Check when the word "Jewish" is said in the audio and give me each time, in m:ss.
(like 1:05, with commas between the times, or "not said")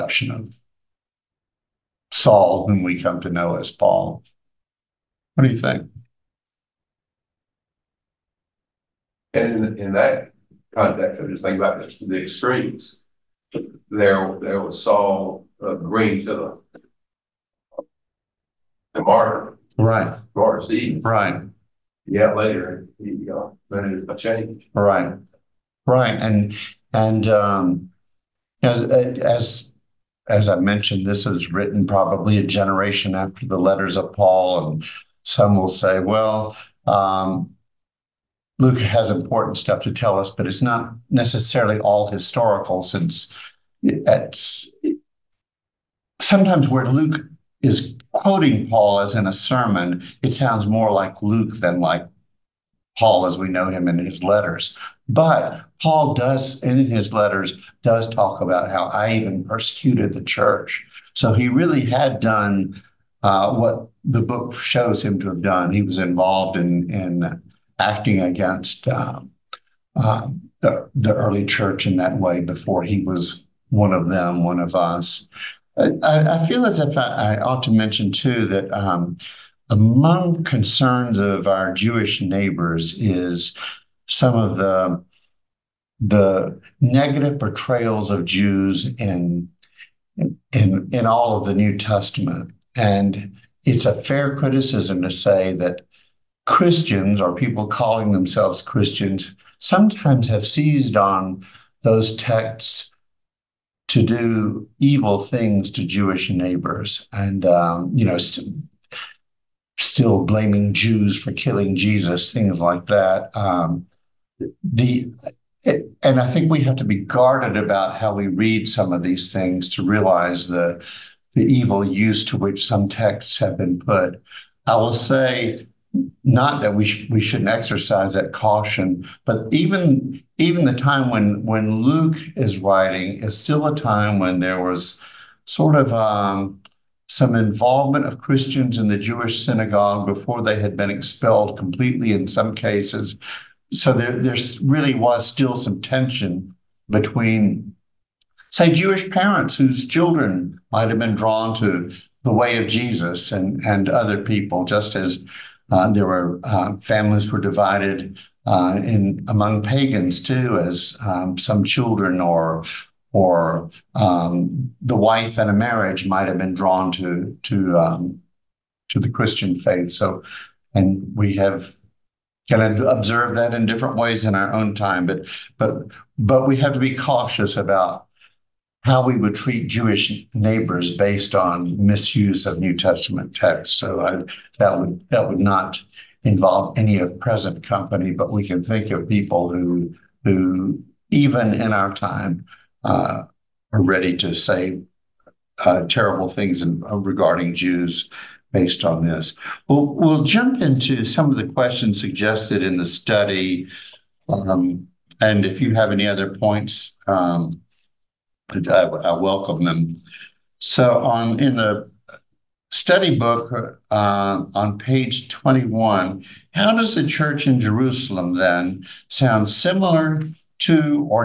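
1:21, 1:45, 2:18, 2:28, 2:59.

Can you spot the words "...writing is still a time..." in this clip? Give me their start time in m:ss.
2:12.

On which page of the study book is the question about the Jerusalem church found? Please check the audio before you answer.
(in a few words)
21.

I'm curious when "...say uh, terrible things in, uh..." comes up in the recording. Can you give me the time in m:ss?
3:14.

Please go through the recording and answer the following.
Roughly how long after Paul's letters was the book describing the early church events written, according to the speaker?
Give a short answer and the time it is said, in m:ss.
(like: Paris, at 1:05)
A generation, at 0:32.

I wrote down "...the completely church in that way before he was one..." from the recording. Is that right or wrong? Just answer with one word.
wrong.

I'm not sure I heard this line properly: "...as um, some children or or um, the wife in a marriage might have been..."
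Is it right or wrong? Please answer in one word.
right.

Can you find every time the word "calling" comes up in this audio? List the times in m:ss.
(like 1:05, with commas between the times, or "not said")
1:37.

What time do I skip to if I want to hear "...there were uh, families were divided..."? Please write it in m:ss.
2:35.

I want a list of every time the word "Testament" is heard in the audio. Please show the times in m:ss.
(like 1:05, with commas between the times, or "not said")
1:31, 3:02.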